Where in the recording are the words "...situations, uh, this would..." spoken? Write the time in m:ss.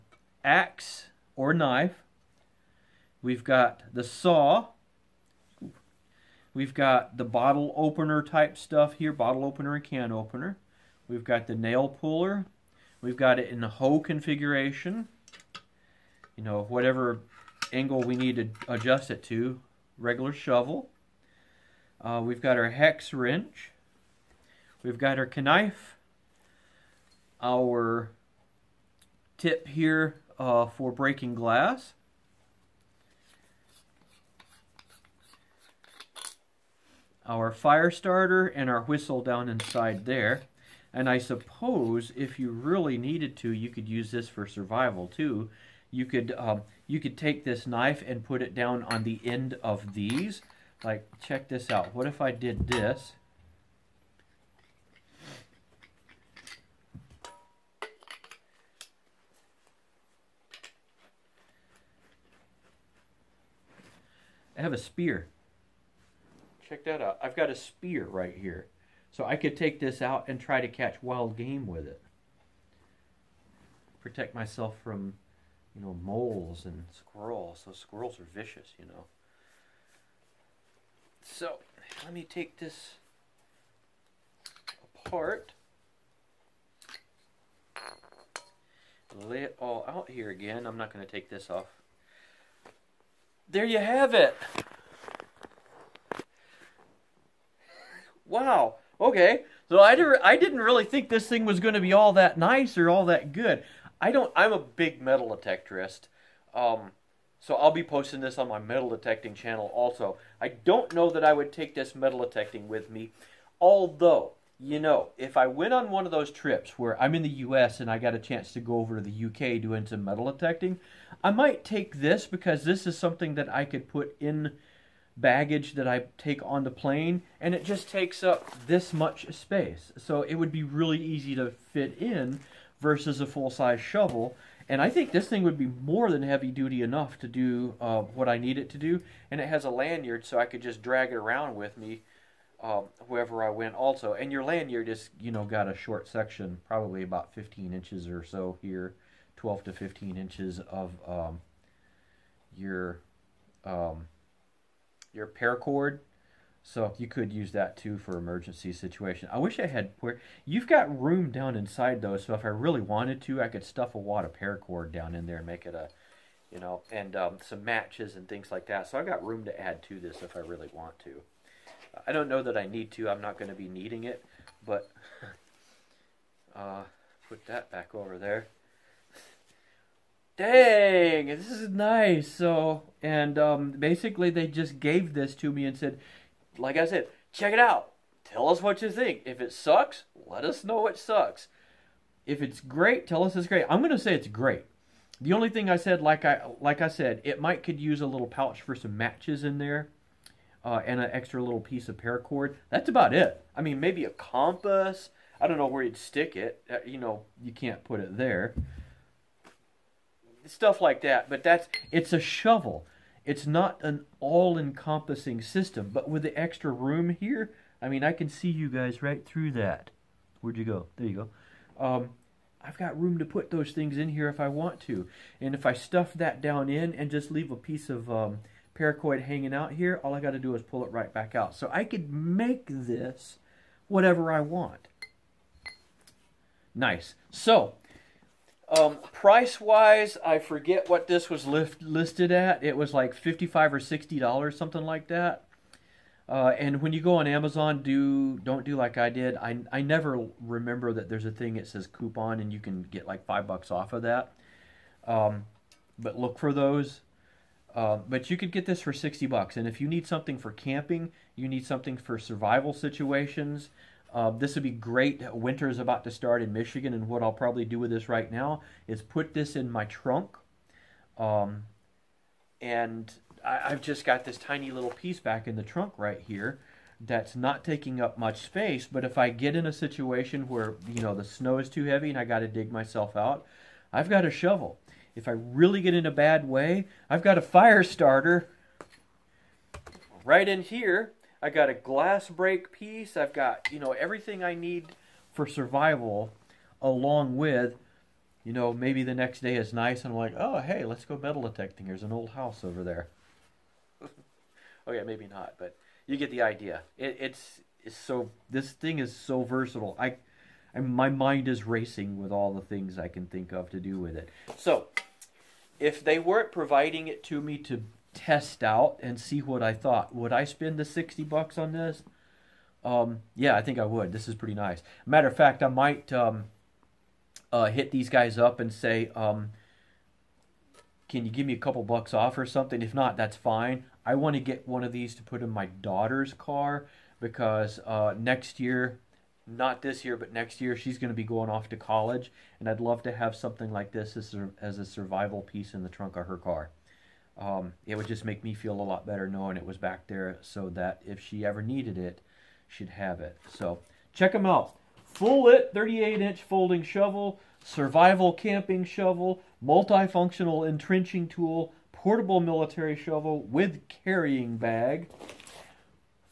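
4:22.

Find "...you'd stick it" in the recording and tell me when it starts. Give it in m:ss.
3:25.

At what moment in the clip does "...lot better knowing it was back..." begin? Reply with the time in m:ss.
5:48.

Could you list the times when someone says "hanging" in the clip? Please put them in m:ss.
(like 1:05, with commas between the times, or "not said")
3:49.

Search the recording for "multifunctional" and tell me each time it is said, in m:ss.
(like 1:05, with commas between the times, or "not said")
5:59.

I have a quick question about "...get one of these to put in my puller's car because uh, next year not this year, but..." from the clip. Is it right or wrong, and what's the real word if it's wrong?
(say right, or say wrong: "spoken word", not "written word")
wrong: "daughter", not "puller".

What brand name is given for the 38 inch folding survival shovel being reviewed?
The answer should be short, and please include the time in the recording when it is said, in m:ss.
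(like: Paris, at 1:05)
FullLit, at 5:55.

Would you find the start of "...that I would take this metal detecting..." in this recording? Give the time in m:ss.
1:51.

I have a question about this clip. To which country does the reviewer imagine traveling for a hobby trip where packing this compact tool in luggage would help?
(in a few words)
UK.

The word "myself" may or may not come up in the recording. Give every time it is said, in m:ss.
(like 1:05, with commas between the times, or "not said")
1:14, 4:42.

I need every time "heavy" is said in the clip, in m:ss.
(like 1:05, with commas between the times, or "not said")
2:16, 4:41.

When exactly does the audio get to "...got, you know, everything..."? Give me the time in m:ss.
4:53.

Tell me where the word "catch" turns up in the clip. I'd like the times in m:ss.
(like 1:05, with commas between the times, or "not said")
1:10.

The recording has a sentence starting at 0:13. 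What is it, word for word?
We've got it in the hoe configuration.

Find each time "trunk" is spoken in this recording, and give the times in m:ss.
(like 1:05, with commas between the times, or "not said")
4:29, 4:35, 5:45.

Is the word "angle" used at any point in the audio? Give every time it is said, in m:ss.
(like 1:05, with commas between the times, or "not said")
0:17.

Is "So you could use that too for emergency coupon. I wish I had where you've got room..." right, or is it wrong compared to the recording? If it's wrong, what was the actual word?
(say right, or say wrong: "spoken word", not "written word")
wrong: "situation", not "coupon".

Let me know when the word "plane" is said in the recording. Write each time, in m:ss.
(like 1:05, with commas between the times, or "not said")
2:06.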